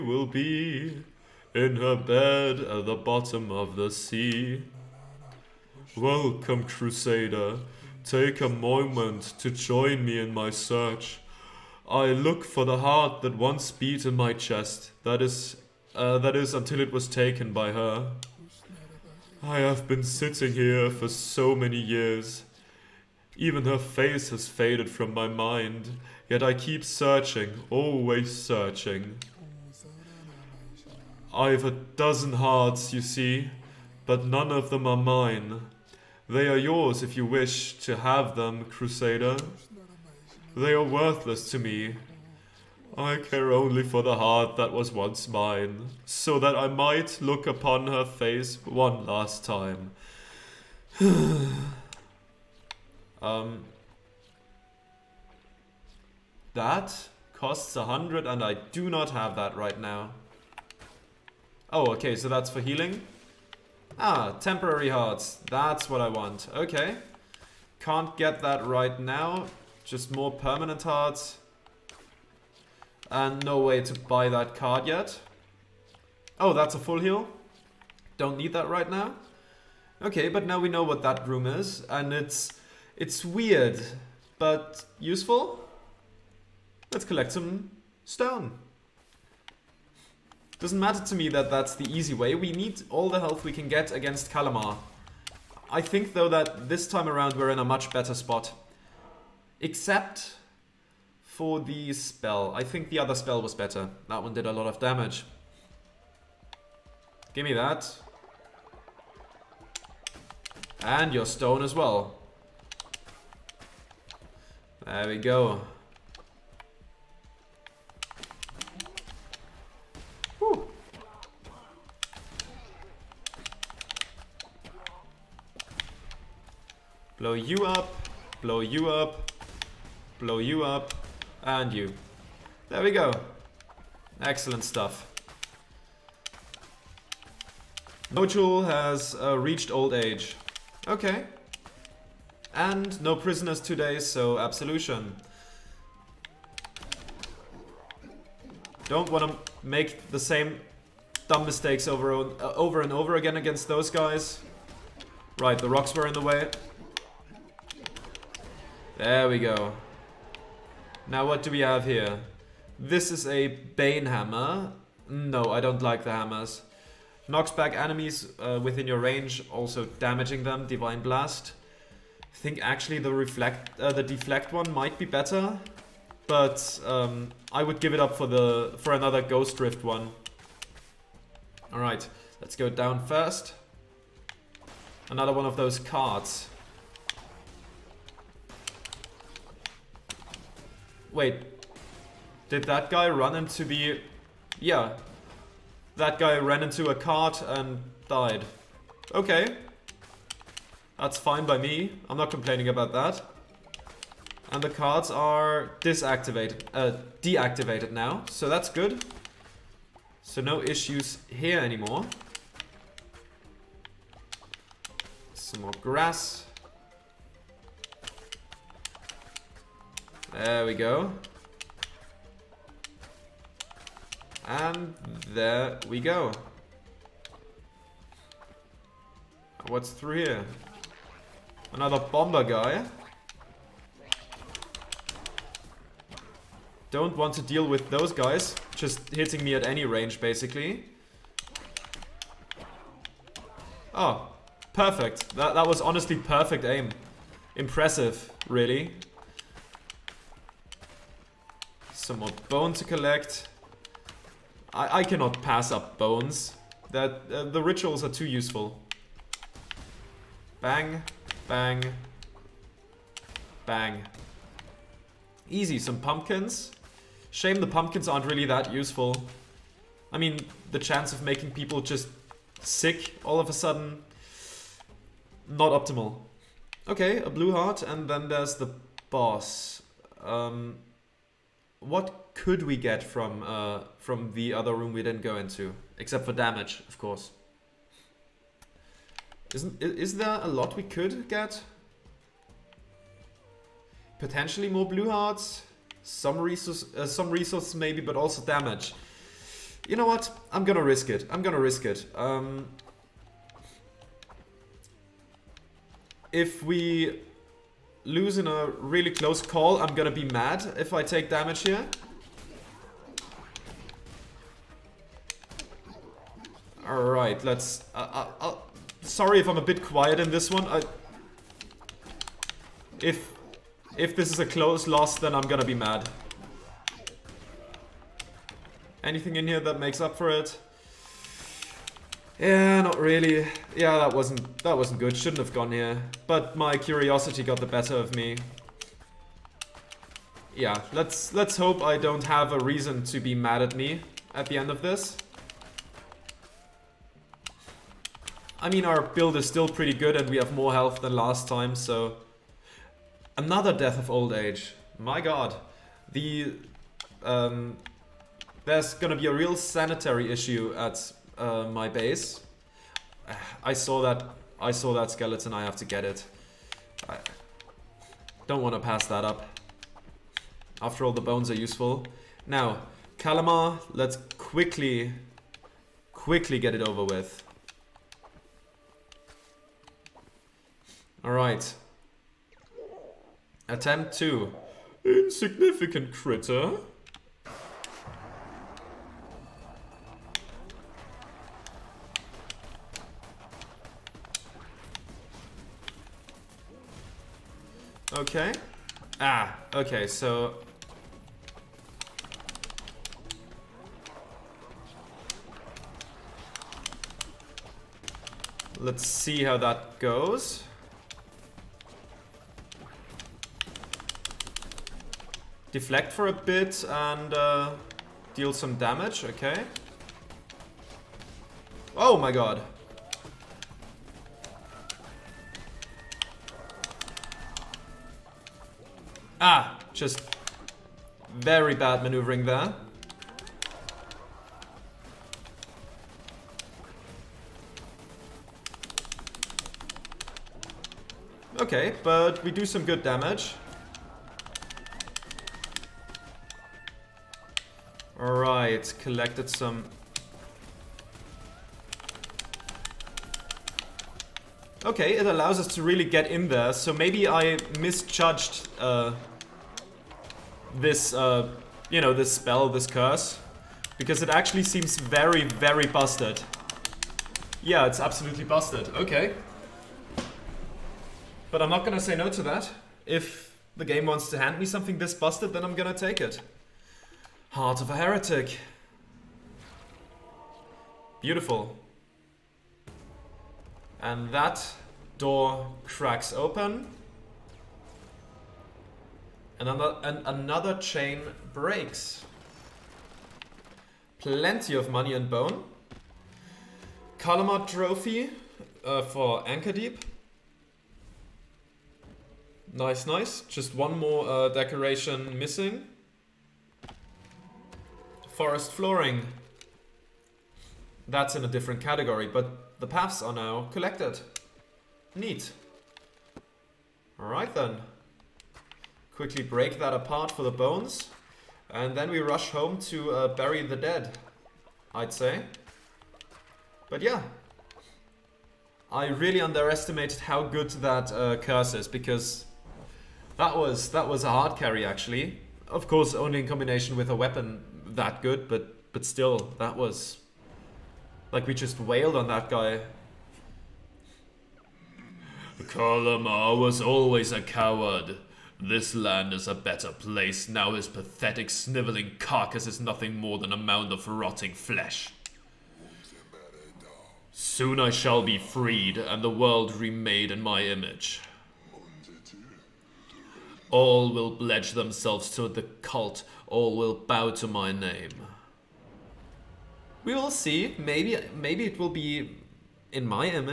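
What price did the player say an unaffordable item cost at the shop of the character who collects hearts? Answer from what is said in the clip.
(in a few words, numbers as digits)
100.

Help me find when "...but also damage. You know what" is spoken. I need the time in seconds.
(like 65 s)
298 s.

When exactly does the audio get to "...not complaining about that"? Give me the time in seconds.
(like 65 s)
202 s.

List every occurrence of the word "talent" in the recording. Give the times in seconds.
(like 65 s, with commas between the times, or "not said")
not said.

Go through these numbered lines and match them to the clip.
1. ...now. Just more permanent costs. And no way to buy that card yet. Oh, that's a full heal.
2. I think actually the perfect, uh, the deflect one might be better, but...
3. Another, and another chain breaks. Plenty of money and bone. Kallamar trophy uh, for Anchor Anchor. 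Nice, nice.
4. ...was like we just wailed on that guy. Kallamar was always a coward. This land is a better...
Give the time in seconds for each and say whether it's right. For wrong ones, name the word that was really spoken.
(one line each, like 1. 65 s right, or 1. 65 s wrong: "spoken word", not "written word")
1. 69 s wrong: "hearts", not "costs"
2. 172 s wrong: "reflect", not "perfect"
3. 489 s wrong: "Deep", not "Anchor"
4. 539 s right.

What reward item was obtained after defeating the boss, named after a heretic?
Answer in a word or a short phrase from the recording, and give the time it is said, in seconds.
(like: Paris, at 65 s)
Heart of a Heretic, at 477 s.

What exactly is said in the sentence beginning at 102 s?
I think the other spell was better.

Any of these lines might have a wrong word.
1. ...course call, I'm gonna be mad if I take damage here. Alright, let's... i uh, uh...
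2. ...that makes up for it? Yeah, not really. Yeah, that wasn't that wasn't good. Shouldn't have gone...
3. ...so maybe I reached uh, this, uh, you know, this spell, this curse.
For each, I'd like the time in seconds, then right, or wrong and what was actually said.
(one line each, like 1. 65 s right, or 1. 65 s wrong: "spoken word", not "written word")
1. 309 s wrong: "close", not "course"
2. 329 s right
3. 456 s wrong: "misjudged", not "reached".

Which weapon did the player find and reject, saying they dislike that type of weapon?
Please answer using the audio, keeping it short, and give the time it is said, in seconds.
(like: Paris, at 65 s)
Bane hammer, at 163 s.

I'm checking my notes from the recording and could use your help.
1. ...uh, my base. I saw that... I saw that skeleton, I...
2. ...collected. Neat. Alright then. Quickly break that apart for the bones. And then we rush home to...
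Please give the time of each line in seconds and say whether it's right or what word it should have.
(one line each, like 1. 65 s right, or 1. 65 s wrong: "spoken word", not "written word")
1. 361 s right
2. 513 s right.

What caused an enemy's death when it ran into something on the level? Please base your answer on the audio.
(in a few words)
A cart.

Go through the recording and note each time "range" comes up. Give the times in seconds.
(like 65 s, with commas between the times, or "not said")
168 s, 239 s.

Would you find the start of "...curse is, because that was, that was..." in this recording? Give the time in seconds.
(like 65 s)
531 s.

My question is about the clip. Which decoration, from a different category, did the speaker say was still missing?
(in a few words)
Forest flooring.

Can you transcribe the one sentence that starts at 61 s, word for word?
Oh, okay, so that's for healing.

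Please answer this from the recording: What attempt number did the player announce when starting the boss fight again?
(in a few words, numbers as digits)
2.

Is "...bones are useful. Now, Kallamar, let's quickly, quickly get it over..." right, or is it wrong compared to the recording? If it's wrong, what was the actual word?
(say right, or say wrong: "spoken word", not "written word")
right.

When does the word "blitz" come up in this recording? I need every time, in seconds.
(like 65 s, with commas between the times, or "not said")
not said.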